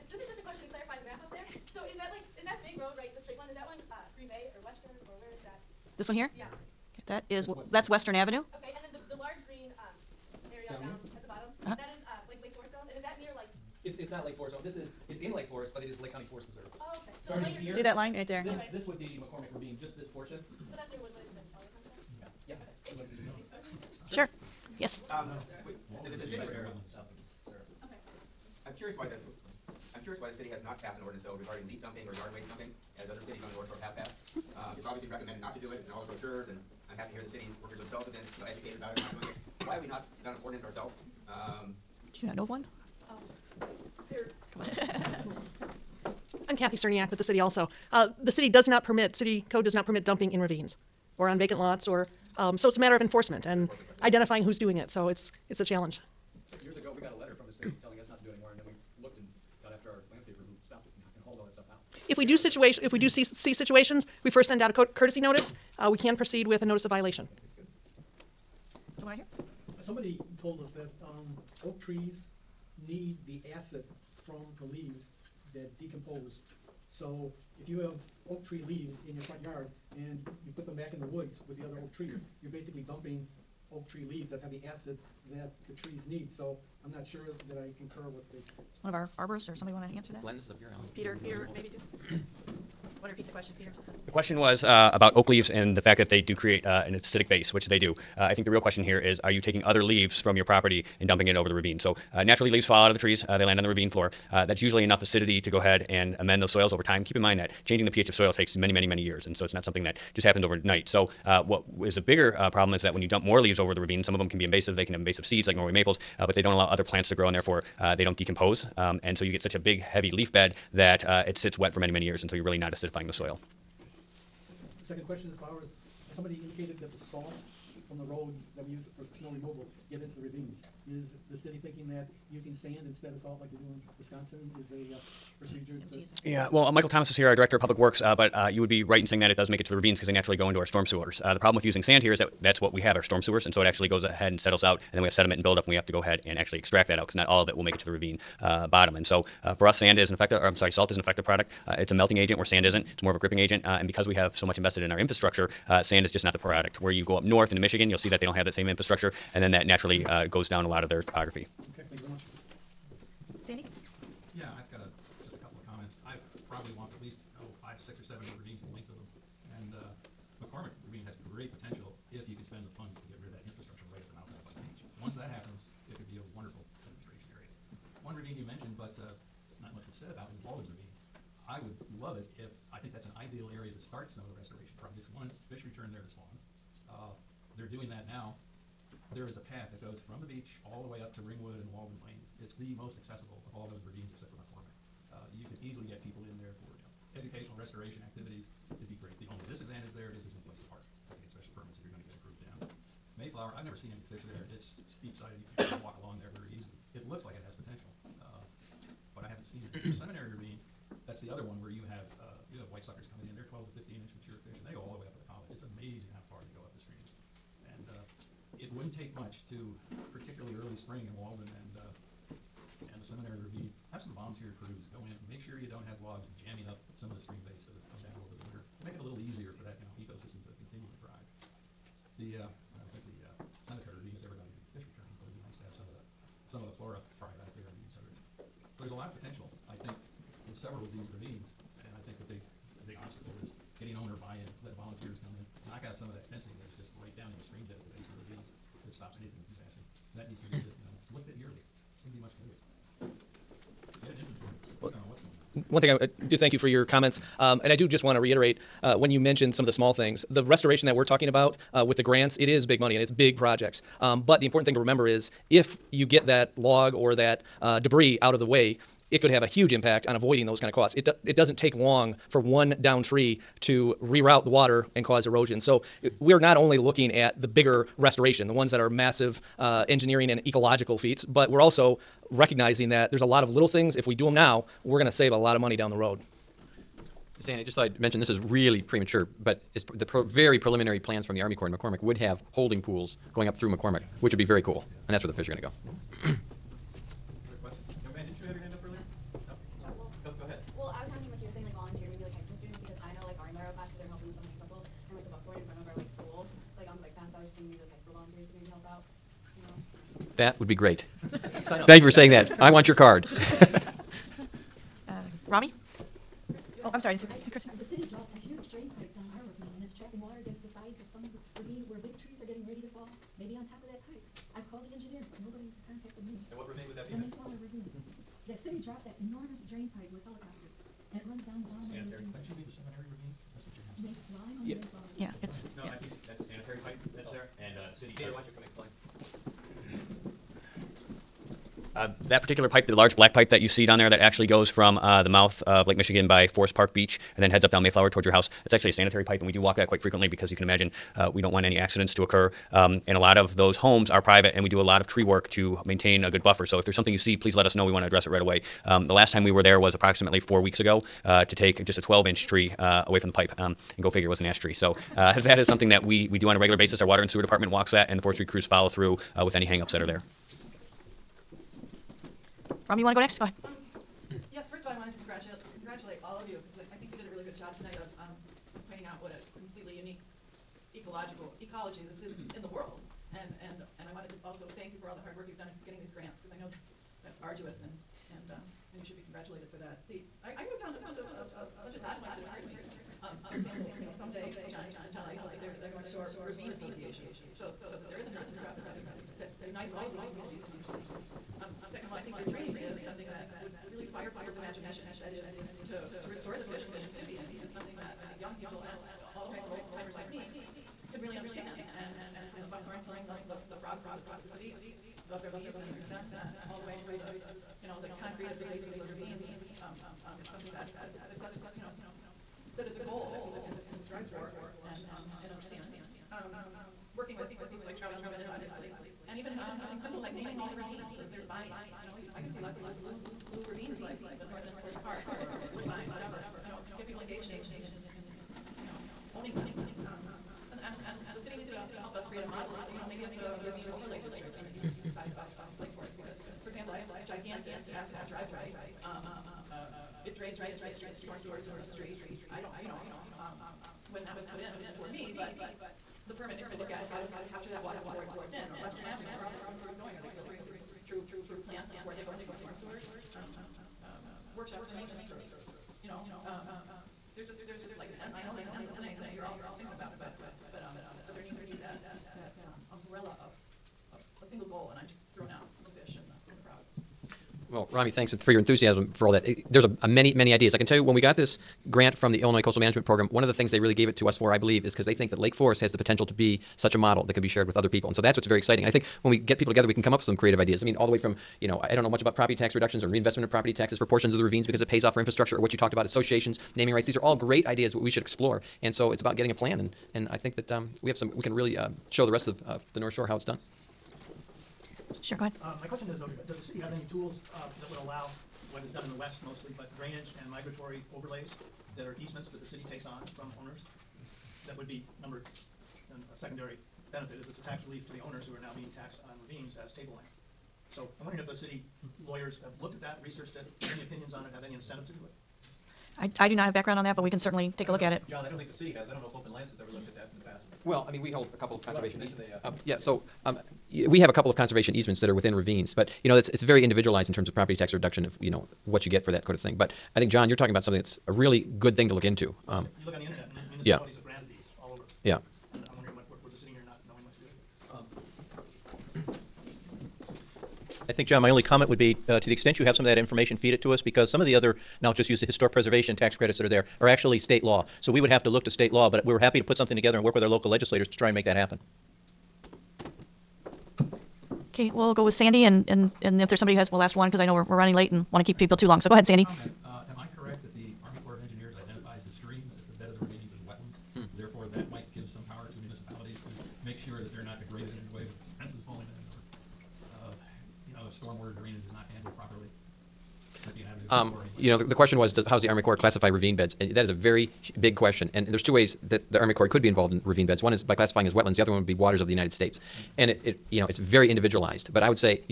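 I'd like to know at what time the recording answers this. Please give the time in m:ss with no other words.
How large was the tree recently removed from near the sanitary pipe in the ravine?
6:02.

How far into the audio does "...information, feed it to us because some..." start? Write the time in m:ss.
9:13.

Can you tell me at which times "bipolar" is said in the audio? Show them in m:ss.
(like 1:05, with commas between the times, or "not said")
not said.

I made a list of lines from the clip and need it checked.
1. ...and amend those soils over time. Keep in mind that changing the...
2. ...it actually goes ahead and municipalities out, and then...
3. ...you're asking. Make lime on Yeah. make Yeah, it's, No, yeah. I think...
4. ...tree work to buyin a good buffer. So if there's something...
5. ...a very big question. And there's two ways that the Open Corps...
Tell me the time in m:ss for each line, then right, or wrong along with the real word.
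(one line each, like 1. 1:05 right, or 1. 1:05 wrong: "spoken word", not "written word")
1. 1:45 right
2. 2:23 wrong: "settles", not "municipalities"
3. 5:33 right
4. 5:55 wrong: "maintain", not "buyin"
5. 9:47 wrong: "Army", not "Open".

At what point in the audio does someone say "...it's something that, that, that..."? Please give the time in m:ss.
7:00.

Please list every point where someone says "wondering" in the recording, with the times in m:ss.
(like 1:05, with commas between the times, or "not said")
8:41, 9:05.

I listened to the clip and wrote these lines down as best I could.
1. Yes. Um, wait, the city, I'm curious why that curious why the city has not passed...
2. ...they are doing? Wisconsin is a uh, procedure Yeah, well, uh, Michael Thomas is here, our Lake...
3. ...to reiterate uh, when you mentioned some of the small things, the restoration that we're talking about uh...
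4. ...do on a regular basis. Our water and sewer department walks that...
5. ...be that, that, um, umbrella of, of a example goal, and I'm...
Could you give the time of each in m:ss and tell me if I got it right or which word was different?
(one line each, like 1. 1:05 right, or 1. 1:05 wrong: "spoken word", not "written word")
1. 0:24 right
2. 2:13 wrong: "Director", not "Lake"
3. 4:18 right
4. 6:06 right
5. 7:51 wrong: "single", not "example".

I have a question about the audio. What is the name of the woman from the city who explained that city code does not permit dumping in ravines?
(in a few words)
Kathy Cerniak.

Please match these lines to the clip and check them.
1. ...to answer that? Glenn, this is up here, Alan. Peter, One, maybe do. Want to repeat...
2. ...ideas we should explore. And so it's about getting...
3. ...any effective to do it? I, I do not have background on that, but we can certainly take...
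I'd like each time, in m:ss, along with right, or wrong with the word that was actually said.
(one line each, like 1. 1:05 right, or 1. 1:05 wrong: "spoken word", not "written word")
1. 1:29 wrong: "Peter", not "One"
2. 8:17 right
3. 8:44 wrong: "incentive", not "effective".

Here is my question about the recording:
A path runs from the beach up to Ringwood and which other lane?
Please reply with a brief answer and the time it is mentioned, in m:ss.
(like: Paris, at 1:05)
Walden Lane, at 3:11.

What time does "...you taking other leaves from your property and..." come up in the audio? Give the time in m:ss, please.
1:39.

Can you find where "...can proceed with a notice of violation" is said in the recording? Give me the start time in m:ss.
1:05.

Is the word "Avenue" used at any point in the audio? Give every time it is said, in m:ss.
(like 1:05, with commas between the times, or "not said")
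0:08, 7:39.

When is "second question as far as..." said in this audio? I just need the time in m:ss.
2:04.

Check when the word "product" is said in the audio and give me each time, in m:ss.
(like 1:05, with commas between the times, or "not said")
2:31, 2:36.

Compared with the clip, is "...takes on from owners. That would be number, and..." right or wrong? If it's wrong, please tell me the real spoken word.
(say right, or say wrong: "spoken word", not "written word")
right.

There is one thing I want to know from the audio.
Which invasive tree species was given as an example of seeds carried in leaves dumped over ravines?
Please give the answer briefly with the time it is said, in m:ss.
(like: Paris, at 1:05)
Norway maples, at 1:55.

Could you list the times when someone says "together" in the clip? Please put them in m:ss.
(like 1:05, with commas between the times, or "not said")
8:09, 9:19.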